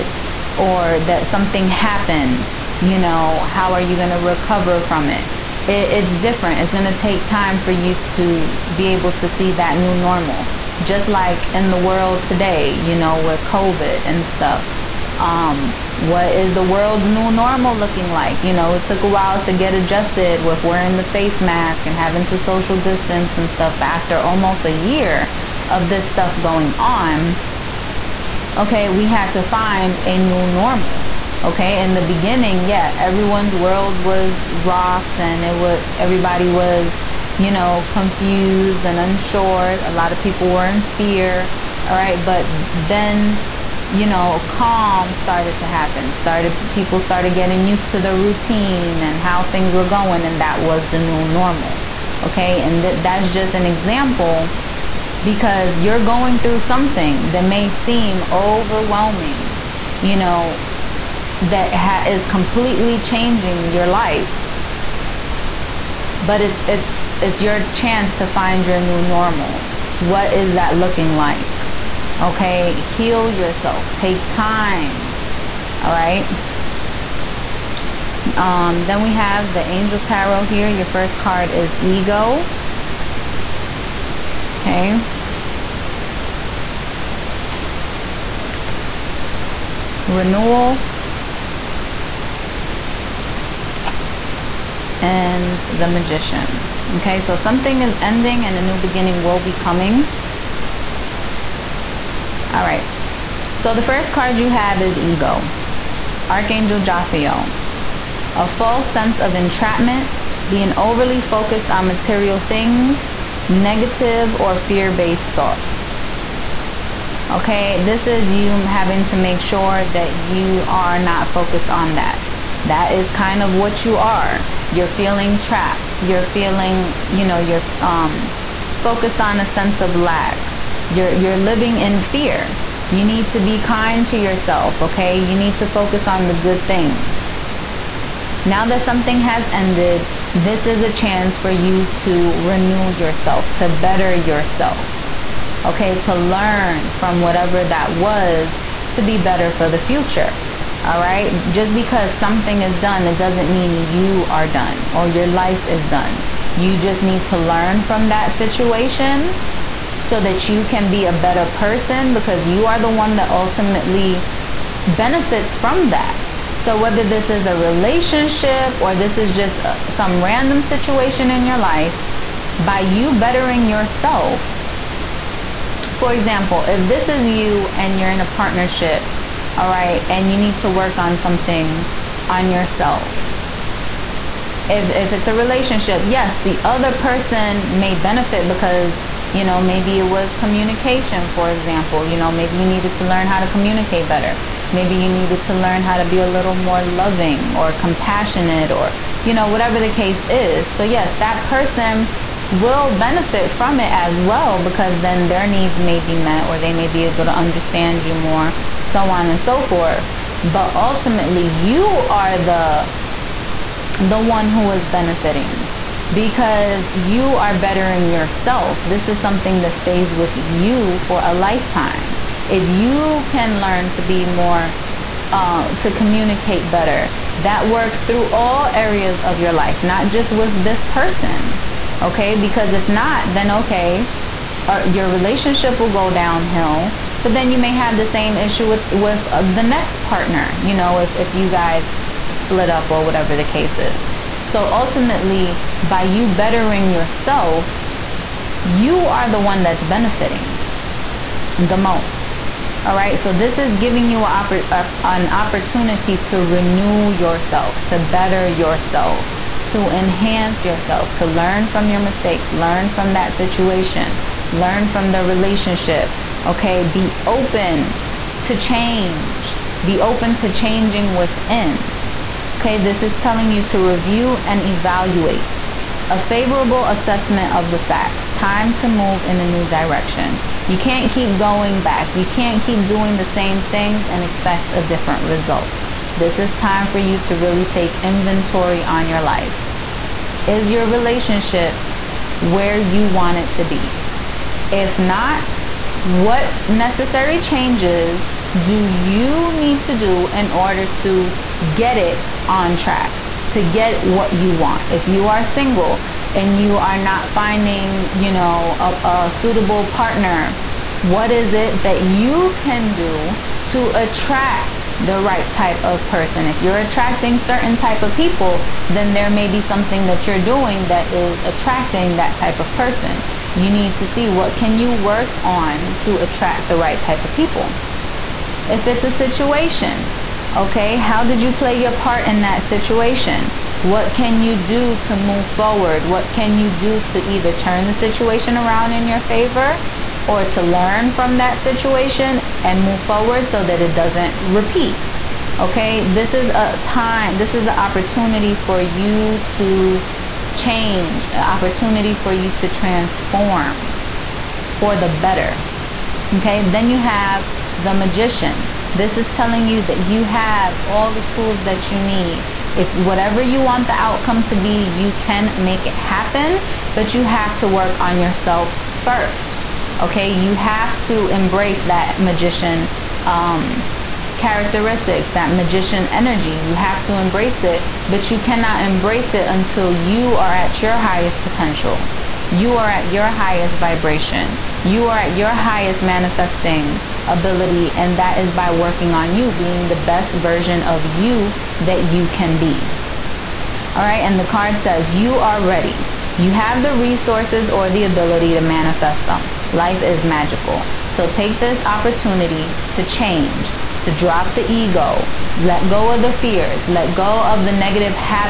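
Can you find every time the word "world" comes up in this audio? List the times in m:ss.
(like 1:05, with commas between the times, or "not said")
0:11, 0:16, 0:33.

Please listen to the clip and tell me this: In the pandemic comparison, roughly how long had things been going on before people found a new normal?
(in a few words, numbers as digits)
almost a year.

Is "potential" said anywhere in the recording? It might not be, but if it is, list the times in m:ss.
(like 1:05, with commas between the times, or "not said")
6:21.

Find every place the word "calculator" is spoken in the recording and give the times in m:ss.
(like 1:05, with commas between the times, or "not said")
not said.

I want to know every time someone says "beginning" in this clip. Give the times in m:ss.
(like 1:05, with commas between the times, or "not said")
0:32, 1:38.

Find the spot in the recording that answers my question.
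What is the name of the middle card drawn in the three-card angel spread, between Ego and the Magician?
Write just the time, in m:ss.
1:30.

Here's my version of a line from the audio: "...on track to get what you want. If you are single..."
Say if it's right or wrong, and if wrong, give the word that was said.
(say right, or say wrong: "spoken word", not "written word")
right.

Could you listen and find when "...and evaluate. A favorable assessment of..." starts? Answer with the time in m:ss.
4:34.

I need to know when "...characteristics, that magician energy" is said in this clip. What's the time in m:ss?
6:14.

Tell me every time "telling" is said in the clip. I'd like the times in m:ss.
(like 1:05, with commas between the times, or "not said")
4:33, 5:59.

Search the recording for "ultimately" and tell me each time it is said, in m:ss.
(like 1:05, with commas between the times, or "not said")
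2:43, 3:30, 4:04.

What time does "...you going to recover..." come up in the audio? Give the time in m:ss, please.
0:03.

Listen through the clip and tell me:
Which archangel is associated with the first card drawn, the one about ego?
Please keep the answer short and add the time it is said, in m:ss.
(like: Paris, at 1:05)
Archangel Jophiel, at 1:46.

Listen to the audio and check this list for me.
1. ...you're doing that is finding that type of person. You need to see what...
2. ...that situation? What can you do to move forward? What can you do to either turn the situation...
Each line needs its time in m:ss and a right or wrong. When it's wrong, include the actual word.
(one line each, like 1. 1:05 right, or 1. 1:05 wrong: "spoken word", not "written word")
1. 5:20 wrong: "attracting", not "finding"
2. 5:32 right.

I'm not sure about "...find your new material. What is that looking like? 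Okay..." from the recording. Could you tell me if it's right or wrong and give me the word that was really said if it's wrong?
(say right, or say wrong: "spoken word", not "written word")
wrong: "normal", not "material".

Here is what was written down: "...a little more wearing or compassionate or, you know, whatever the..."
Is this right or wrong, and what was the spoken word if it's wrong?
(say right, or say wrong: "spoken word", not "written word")
wrong: "loving", not "wearing".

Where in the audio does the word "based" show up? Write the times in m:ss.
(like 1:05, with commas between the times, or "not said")
1:54.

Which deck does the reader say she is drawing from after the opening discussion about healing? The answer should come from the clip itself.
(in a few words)
Angel Tarot.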